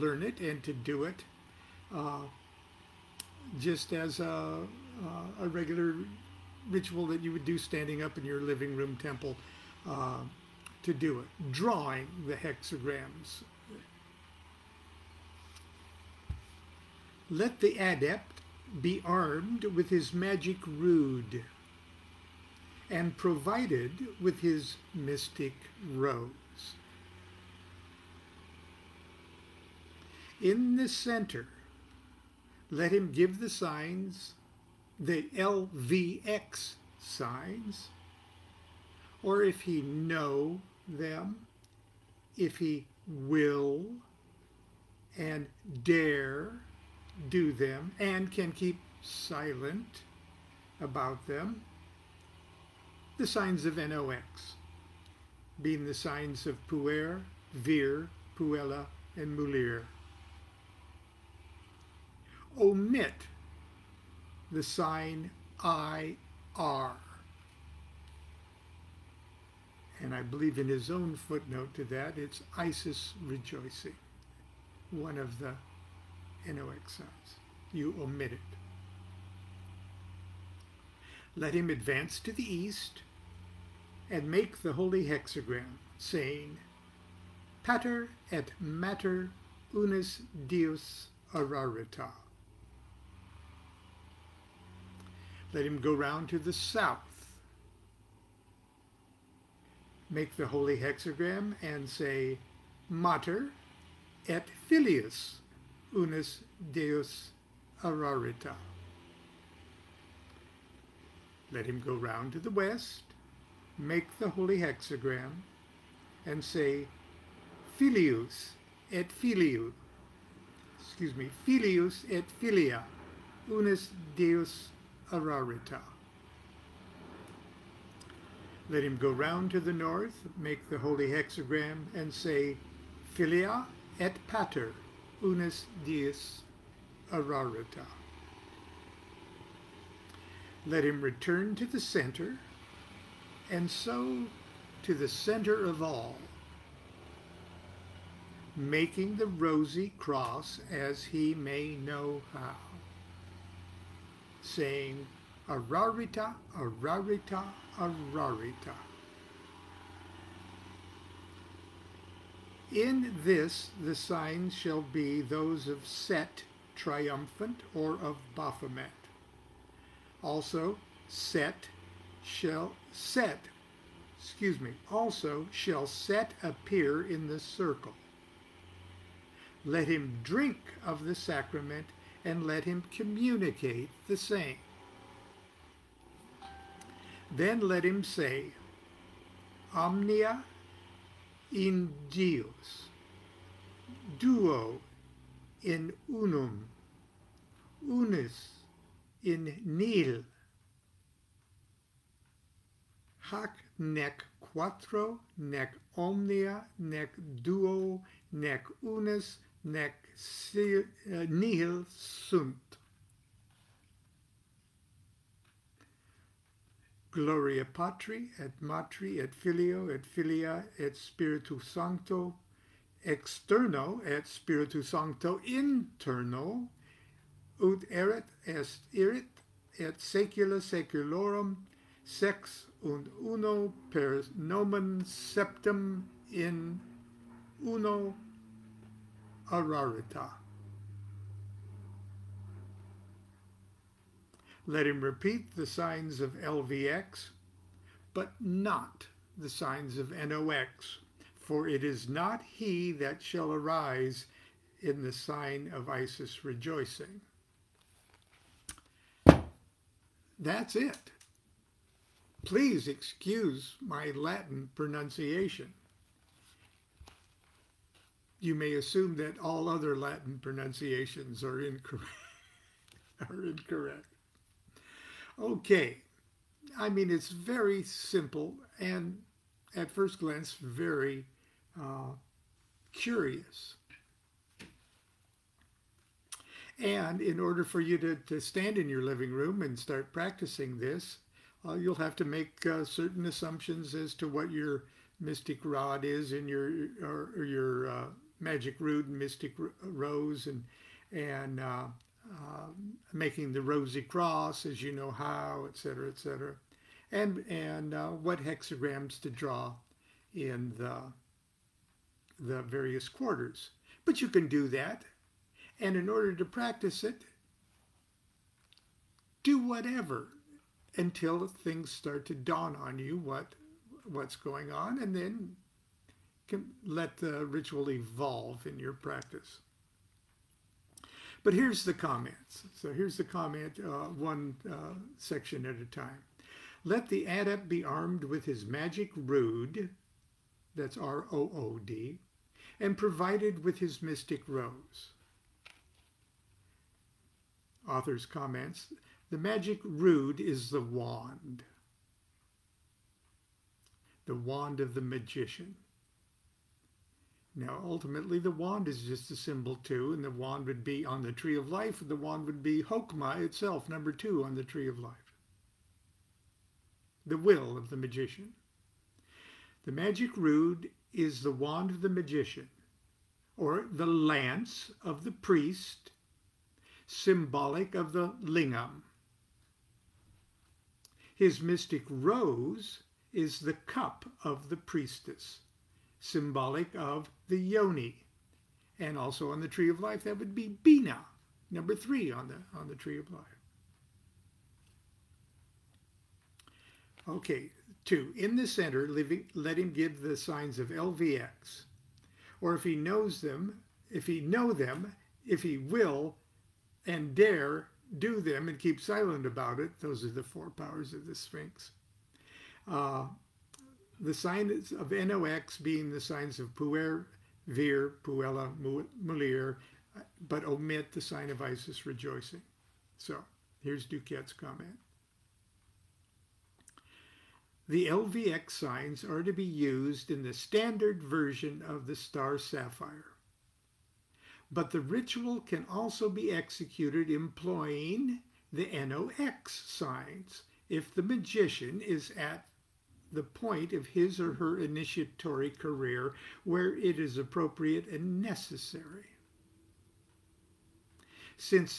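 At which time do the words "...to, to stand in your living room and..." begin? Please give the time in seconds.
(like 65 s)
287 s.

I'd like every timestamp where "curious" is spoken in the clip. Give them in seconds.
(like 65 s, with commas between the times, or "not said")
282 s.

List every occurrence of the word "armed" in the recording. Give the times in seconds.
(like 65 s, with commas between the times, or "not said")
19 s, 337 s.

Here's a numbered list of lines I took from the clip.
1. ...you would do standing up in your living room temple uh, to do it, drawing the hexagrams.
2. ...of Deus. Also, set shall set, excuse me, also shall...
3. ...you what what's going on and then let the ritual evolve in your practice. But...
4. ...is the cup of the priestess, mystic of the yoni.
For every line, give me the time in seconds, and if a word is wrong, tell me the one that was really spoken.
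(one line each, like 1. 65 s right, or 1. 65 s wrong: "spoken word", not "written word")
1. 7 s right
2. 168 s wrong: "Baphomet", not "Deus"
3. 322 s right
4. 383 s wrong: "symbolic", not "mystic".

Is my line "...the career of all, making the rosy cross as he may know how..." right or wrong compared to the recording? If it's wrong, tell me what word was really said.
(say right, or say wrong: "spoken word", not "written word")
wrong: "center", not "career".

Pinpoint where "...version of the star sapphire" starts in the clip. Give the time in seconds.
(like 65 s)
431 s.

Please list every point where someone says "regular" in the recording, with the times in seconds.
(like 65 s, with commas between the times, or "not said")
5 s.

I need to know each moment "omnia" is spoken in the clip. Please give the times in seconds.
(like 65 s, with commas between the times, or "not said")
189 s, 205 s.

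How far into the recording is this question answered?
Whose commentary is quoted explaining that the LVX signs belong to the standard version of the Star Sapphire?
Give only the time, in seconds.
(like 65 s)
424 s.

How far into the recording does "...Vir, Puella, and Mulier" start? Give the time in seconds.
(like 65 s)
57 s.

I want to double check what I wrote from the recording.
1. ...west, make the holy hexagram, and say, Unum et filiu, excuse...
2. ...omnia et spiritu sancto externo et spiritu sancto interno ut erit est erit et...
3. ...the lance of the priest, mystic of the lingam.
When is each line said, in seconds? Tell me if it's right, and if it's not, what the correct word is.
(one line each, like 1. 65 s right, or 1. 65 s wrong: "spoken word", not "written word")
1. 112 s wrong: "Filius", not "Unum"
2. 220 s wrong: "filia", not "omnia"
3. 373 s wrong: "symbolic", not "mystic".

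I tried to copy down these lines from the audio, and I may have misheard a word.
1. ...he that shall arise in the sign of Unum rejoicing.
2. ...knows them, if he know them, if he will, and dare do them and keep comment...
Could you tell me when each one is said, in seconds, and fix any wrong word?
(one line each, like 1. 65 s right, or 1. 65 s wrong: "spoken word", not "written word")
1. 252 s wrong: "Isis", not "Unum"
2. 402 s wrong: "silent", not "comment".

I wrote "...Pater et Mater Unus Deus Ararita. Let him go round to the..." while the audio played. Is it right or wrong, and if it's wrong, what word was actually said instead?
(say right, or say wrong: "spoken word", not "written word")
right.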